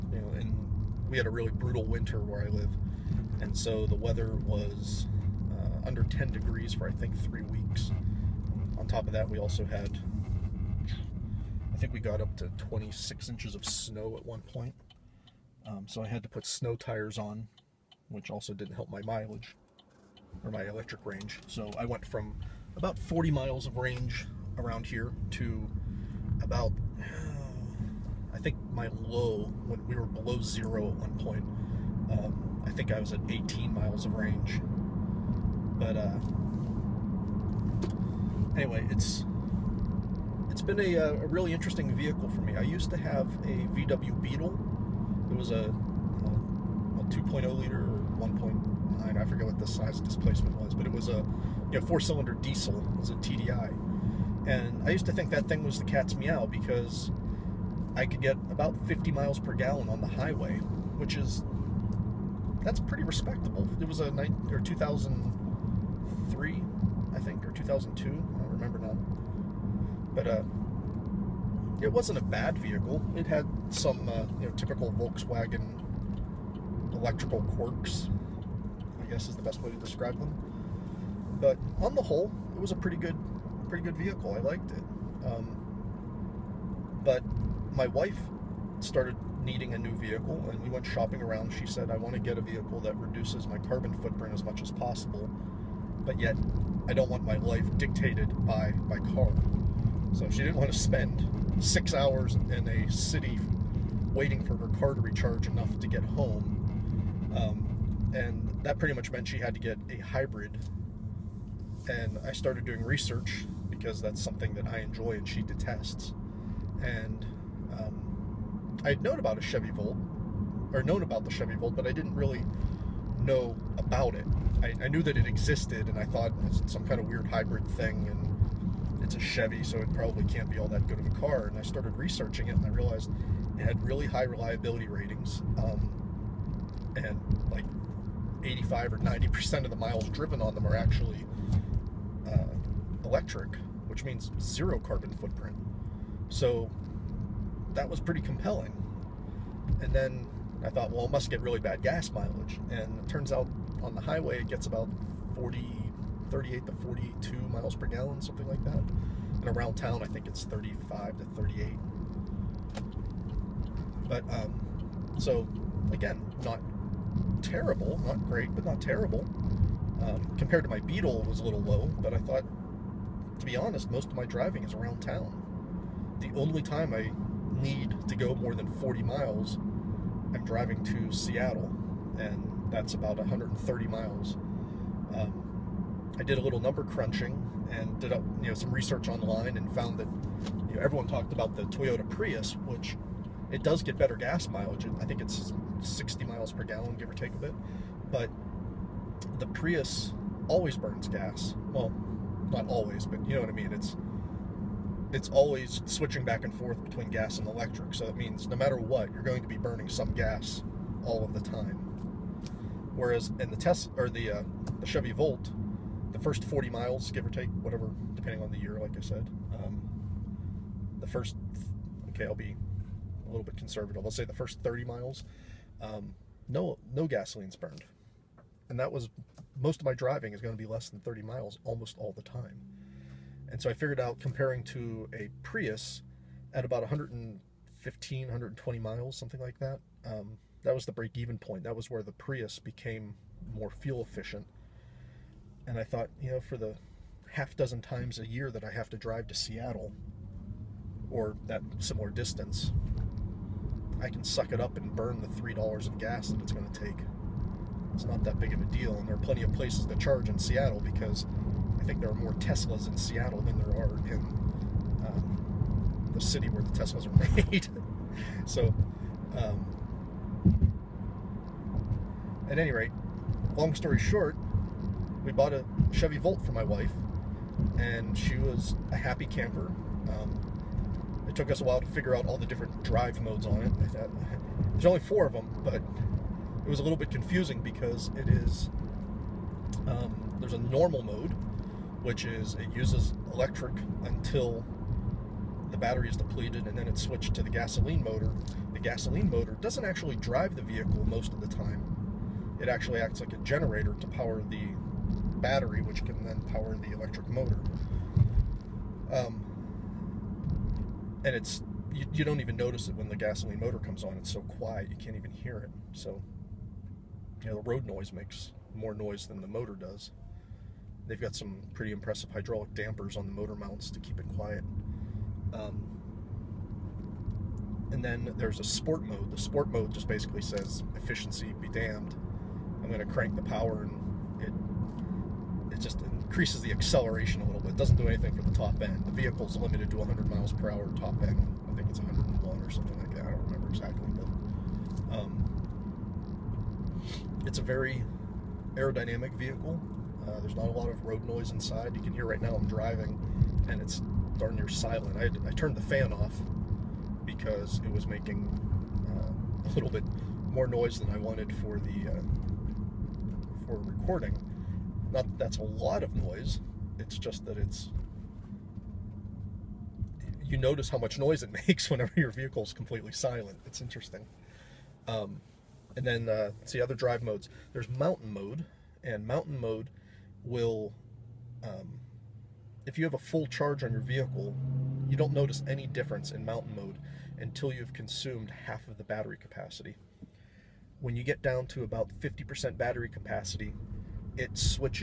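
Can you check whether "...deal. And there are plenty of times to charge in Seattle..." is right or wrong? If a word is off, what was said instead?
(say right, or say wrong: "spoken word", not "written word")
wrong: "places", not "times".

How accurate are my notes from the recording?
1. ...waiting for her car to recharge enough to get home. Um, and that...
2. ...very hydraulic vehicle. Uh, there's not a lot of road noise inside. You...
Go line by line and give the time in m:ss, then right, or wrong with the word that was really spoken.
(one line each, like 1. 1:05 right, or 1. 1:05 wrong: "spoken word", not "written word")
1. 1:44 right
2. 5:47 wrong: "aerodynamic", not "hydraulic".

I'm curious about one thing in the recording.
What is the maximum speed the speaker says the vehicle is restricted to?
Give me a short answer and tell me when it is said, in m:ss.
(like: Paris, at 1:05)
100 mph, at 5:39.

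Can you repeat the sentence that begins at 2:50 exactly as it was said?
Um, compared to my Beetle, was a little low, but I thought, to be honest, most of my driving is around town.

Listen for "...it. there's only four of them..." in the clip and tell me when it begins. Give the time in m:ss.
4:43.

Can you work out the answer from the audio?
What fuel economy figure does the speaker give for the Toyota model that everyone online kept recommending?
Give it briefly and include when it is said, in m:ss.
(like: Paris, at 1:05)
60 mpg, at 3:15.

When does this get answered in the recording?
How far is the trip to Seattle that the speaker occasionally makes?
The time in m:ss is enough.
3:03.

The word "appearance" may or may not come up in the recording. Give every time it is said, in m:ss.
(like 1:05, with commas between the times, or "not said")
not said.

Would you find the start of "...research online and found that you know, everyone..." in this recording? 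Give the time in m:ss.
3:08.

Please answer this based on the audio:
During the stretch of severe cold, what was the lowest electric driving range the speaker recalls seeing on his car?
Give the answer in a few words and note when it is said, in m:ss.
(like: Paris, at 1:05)
18 miles, at 0:33.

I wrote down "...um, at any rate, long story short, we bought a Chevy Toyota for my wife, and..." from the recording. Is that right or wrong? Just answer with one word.
wrong.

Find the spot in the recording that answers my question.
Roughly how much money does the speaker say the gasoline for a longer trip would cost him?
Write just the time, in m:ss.
4:15.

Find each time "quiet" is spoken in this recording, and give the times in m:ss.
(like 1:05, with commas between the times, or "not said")
5:14, 5:24.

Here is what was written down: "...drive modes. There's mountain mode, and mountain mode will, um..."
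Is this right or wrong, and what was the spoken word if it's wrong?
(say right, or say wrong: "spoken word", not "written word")
right.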